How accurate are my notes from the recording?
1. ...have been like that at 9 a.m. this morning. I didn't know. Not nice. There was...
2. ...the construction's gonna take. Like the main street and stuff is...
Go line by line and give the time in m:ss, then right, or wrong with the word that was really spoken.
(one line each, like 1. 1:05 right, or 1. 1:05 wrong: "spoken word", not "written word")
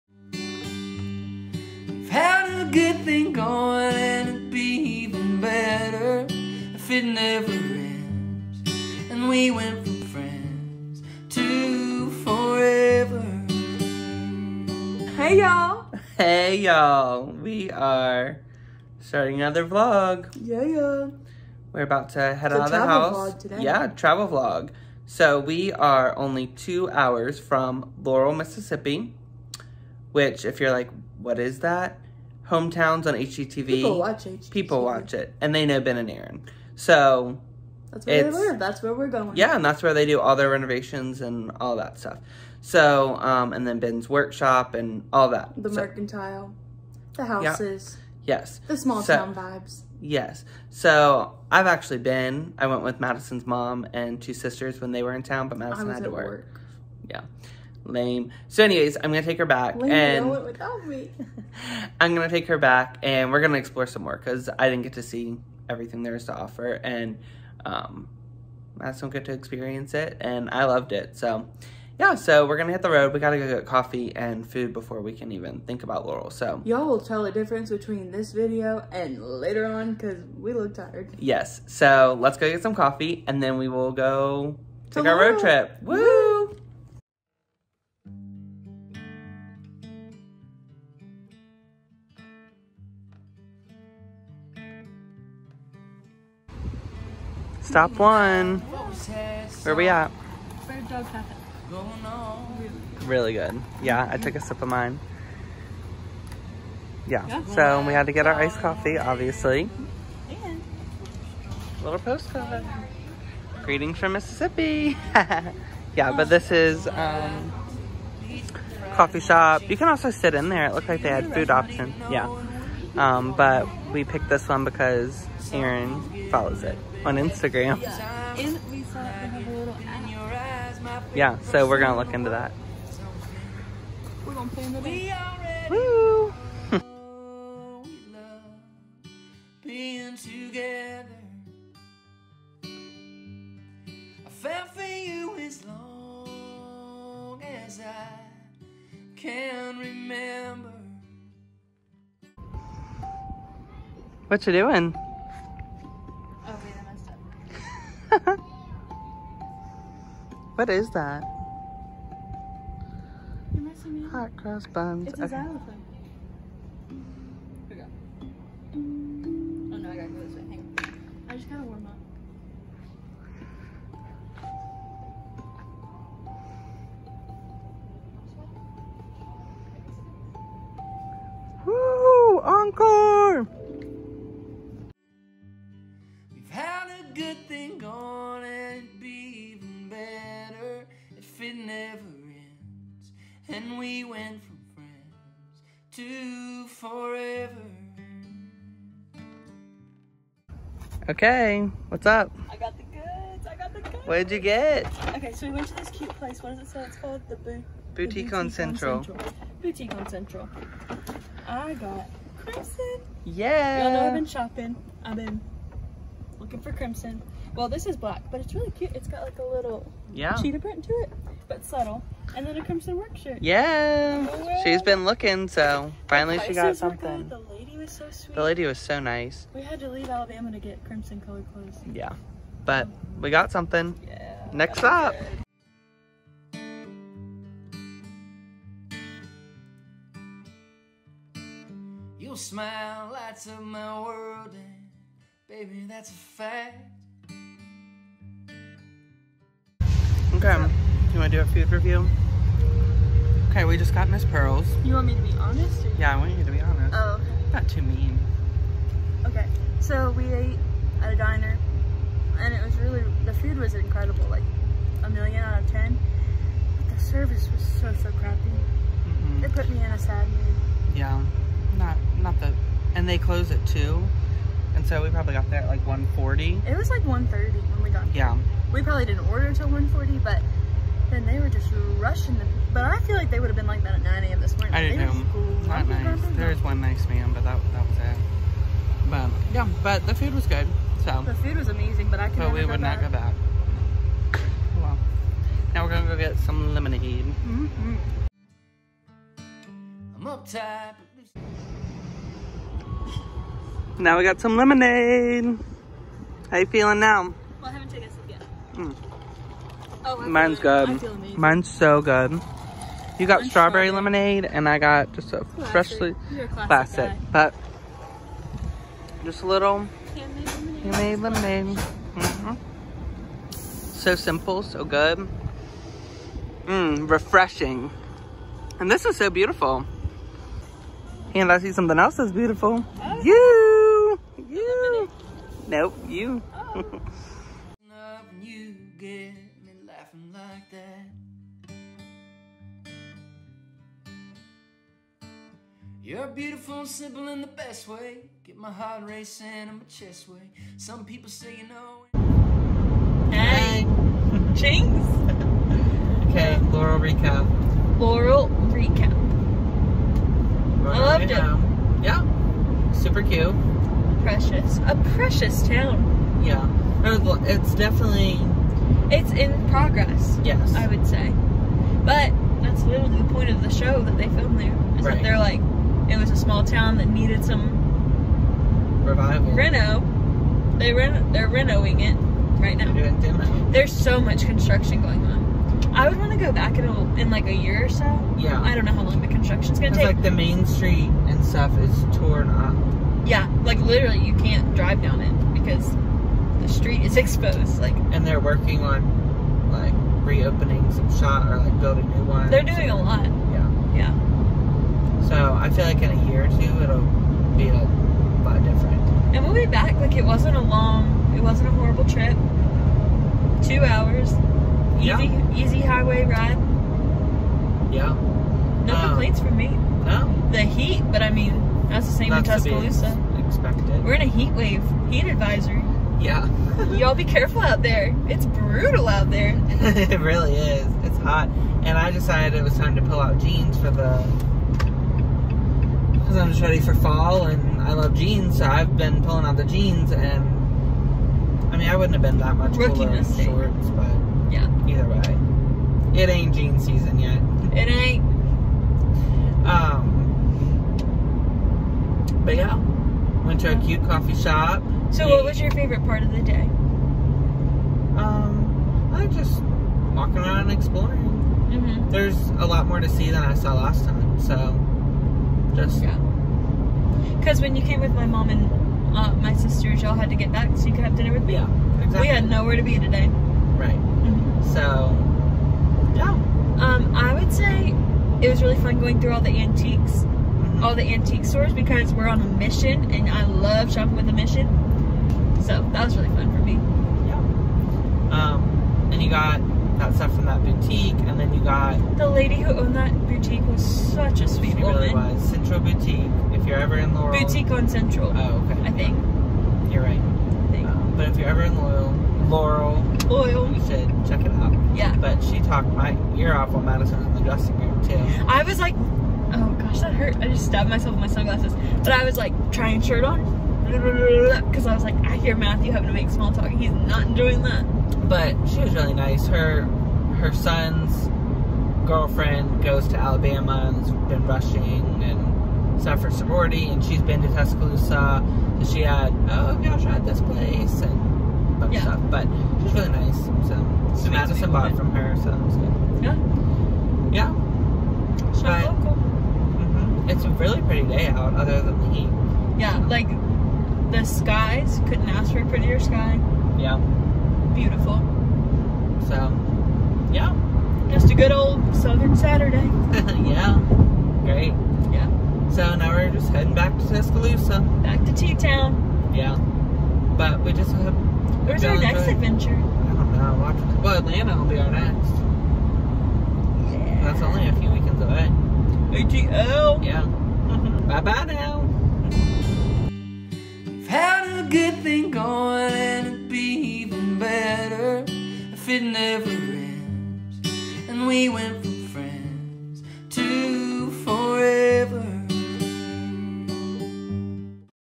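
1. 4:43 right
2. 6:29 right.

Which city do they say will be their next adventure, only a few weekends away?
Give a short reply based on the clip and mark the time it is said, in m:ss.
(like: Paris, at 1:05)
Atlanta, at 9:24.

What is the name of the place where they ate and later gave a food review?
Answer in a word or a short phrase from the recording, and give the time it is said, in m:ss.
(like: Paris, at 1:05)
Miss Pearls, at 4:14.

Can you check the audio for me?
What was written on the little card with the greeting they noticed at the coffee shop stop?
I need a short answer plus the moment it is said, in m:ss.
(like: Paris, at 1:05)
Greetings from Mississippi, at 1:53.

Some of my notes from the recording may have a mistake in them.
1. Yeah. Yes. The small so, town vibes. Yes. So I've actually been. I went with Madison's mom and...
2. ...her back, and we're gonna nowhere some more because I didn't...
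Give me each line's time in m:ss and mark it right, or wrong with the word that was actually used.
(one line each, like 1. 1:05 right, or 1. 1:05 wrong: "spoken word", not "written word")
1. 0:47 right
2. 1:02 wrong: "explore", not "nowhere".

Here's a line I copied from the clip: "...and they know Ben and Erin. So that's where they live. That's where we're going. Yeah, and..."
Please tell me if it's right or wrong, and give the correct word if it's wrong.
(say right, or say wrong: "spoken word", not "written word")
right.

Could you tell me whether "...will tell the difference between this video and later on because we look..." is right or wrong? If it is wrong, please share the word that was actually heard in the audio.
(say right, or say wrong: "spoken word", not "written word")
right.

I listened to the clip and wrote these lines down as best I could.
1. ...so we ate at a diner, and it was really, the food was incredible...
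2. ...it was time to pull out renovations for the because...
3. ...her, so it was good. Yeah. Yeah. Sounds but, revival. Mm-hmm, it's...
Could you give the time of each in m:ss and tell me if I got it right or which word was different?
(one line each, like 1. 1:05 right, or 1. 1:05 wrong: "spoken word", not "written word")
1. 4:19 right
2. 7:12 wrong: "jeans", not "renovations"
3. 8:55 wrong: "local", not "revival".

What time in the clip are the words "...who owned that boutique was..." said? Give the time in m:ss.
8:12.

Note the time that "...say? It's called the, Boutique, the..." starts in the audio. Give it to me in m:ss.
3:26.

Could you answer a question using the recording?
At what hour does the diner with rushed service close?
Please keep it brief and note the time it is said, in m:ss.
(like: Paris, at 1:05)
2, at 4:33.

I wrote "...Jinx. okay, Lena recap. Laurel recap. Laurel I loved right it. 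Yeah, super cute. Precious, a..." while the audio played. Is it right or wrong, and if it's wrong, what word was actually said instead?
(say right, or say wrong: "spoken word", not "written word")
wrong: "Laurel", not "Lena".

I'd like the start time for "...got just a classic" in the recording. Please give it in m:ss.
5:14.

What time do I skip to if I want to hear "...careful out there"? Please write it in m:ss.
7:07.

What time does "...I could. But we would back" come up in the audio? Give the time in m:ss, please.
4:52.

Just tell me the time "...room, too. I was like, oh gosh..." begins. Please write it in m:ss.
8:27.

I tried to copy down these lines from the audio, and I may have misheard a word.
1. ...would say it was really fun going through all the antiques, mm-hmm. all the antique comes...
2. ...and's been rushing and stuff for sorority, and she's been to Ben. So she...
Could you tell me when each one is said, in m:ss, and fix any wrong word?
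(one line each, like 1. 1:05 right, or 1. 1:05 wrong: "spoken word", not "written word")
1. 7:57 wrong: "stores", not "comes"
2. 8:43 wrong: "Tuscaloosa", not "Ben".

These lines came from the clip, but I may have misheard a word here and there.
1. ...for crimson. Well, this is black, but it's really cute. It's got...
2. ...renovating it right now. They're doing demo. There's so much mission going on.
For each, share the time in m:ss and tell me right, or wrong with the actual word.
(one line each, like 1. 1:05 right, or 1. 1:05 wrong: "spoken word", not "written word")
1. 3:36 right
2. 6:21 wrong: "construction", not "mission".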